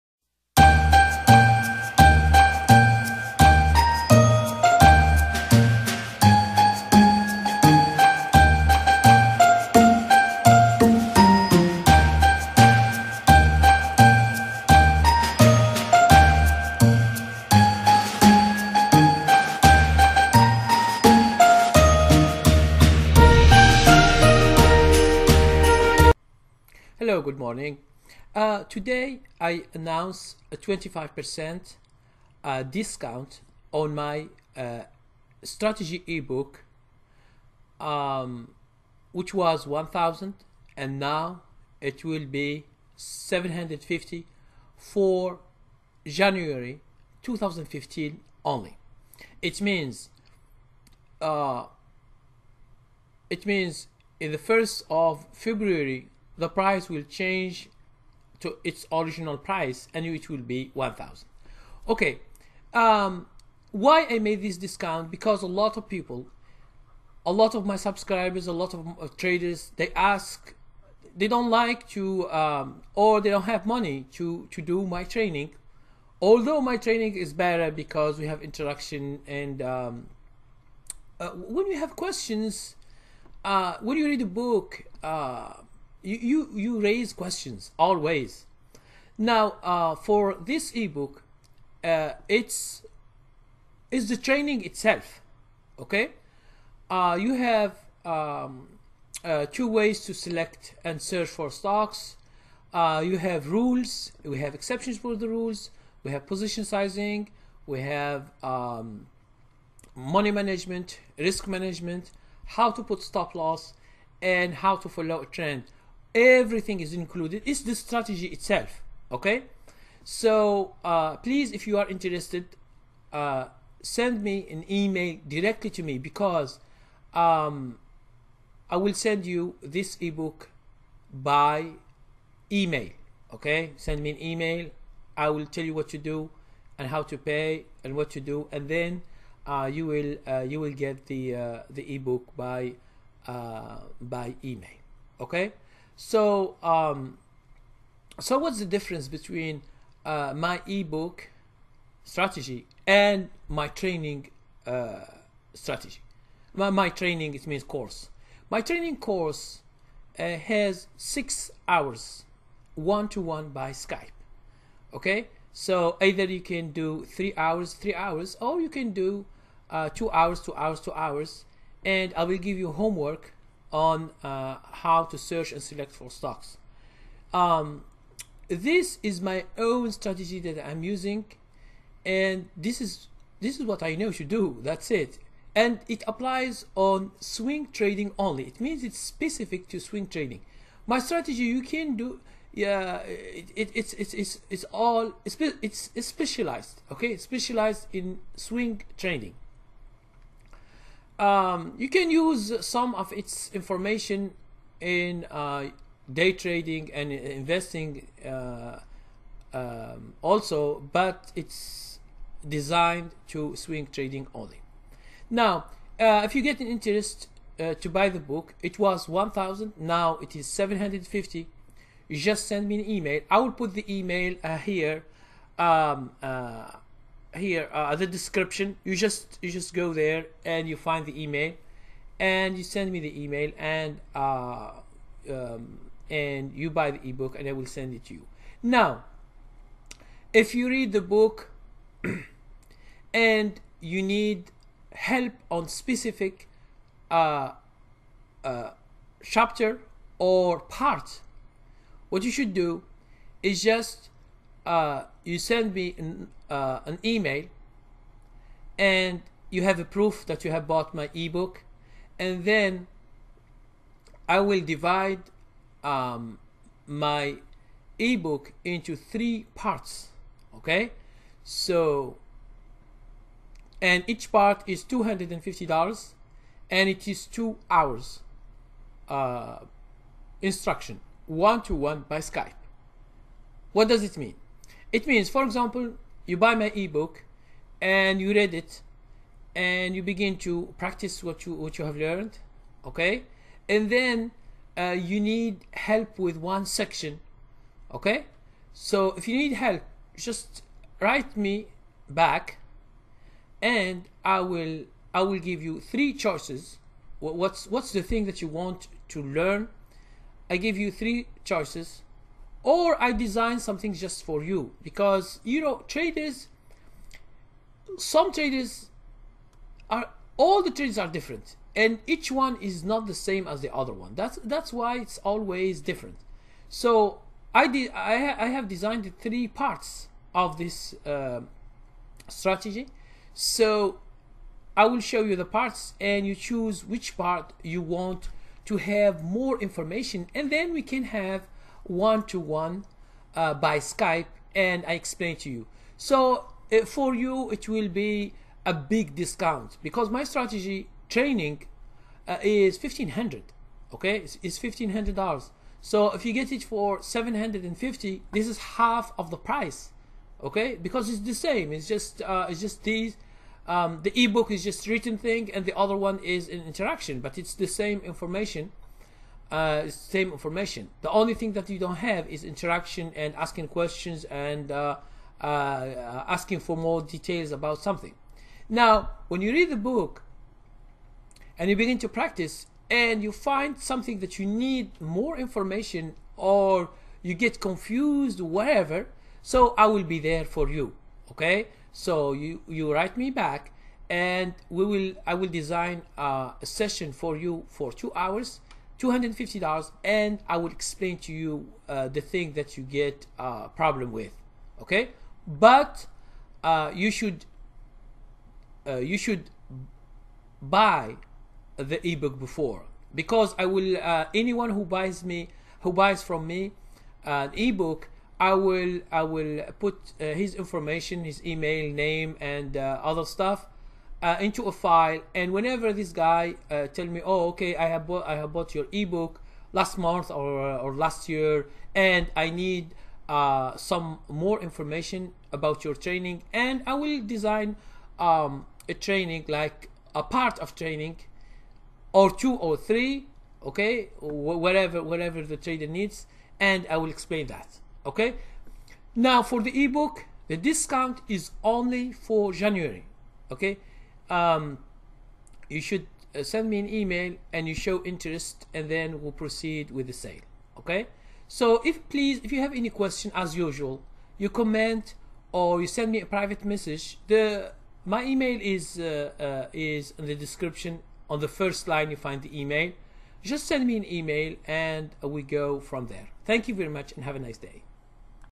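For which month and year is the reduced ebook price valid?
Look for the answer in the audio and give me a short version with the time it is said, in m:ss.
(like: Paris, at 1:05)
January 2015, at 0:46.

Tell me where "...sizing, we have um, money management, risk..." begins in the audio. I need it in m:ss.
1:46.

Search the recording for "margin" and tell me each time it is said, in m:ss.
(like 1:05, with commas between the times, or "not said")
not said.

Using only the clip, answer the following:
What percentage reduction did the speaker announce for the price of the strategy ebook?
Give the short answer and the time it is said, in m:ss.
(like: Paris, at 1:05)
25%, at 0:30.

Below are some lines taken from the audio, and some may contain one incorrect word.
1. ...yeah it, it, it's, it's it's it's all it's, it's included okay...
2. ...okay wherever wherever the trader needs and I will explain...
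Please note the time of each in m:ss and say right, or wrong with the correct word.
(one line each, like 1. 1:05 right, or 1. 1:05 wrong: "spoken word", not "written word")
1. 3:12 wrong: "specialized", not "included"
2. 7:23 right.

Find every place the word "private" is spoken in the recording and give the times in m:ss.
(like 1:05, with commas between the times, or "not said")
7:46.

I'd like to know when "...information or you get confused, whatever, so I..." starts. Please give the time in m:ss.
6:25.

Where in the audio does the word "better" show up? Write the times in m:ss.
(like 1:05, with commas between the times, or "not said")
1:17.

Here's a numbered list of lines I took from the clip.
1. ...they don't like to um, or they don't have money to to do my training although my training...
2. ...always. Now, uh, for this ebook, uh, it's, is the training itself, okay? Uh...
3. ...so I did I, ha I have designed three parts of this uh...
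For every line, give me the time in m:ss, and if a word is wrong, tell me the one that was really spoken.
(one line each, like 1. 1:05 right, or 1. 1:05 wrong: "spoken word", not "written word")
1. 1:11 right
2. 1:27 right
3. 5:26 right.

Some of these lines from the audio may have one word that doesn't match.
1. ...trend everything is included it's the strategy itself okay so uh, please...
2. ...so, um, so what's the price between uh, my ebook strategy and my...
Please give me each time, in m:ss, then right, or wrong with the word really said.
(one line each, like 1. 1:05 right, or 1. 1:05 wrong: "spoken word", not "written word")
1. 1:55 right
2. 2:26 wrong: "difference", not "price".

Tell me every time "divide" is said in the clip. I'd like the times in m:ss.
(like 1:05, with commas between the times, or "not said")
4:24.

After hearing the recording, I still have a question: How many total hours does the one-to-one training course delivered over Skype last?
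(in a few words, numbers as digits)
6 hours.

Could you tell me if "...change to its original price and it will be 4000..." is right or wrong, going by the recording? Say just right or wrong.
wrong.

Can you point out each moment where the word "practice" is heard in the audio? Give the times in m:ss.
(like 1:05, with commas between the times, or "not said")
4:50, 6:22.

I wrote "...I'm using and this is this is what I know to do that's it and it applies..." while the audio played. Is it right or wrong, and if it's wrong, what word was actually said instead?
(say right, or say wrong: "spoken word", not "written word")
right.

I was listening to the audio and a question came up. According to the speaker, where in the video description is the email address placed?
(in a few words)
On the first line.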